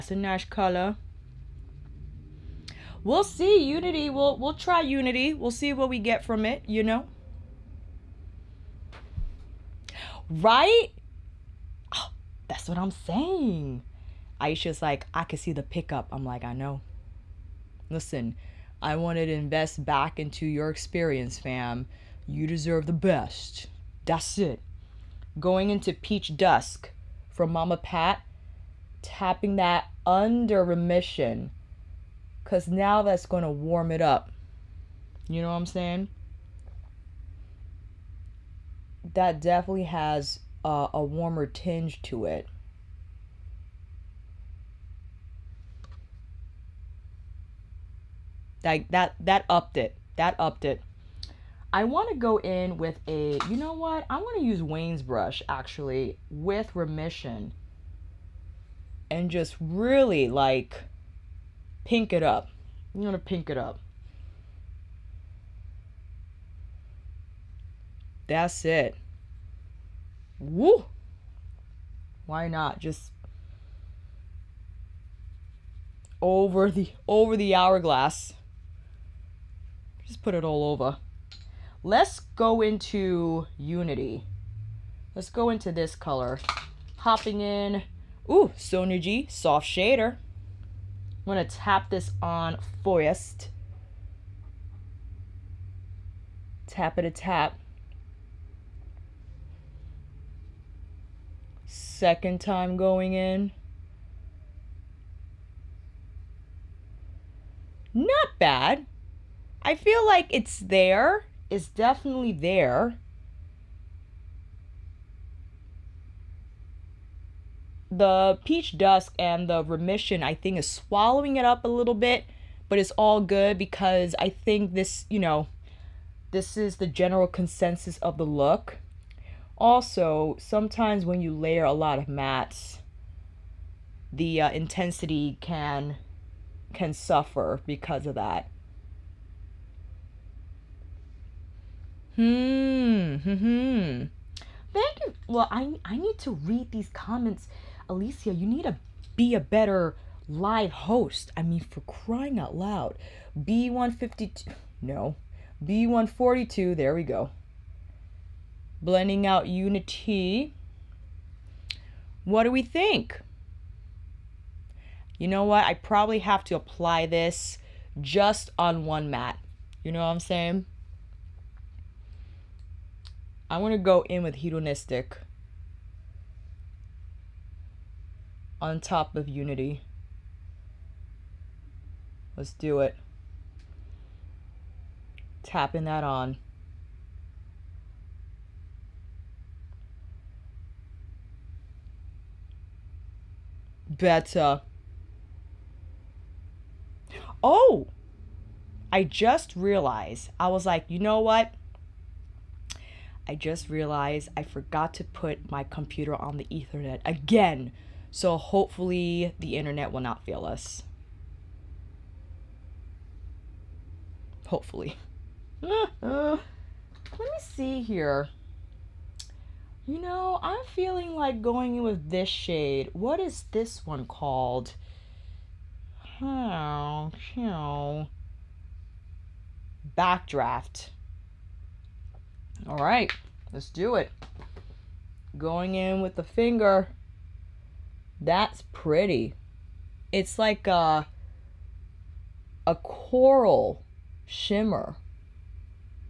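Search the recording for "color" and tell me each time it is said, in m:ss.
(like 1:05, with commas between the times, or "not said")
0:00, 1:25.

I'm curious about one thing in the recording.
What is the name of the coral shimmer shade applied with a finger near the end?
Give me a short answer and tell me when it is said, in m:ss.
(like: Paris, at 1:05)
Backdraft, at 3:49.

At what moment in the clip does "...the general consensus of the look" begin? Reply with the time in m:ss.
2:06.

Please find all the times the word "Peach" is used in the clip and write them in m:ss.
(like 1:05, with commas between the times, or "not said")
0:25, 1:58.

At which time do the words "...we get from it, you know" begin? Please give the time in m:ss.
0:05.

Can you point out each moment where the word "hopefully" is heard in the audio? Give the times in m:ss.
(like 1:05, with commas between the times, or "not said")
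3:28, 3:34.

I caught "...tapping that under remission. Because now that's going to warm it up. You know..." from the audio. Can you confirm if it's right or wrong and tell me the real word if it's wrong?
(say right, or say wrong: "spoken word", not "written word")
right.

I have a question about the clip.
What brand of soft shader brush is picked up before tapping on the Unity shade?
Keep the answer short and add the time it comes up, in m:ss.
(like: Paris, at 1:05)
Sonia G, at 1:28.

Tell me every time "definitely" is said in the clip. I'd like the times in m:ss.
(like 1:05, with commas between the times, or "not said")
0:39, 1:51.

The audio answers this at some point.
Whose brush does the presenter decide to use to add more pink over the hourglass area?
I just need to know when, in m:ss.
0:54.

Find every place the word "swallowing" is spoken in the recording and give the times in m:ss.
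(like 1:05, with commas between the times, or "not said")
2:00.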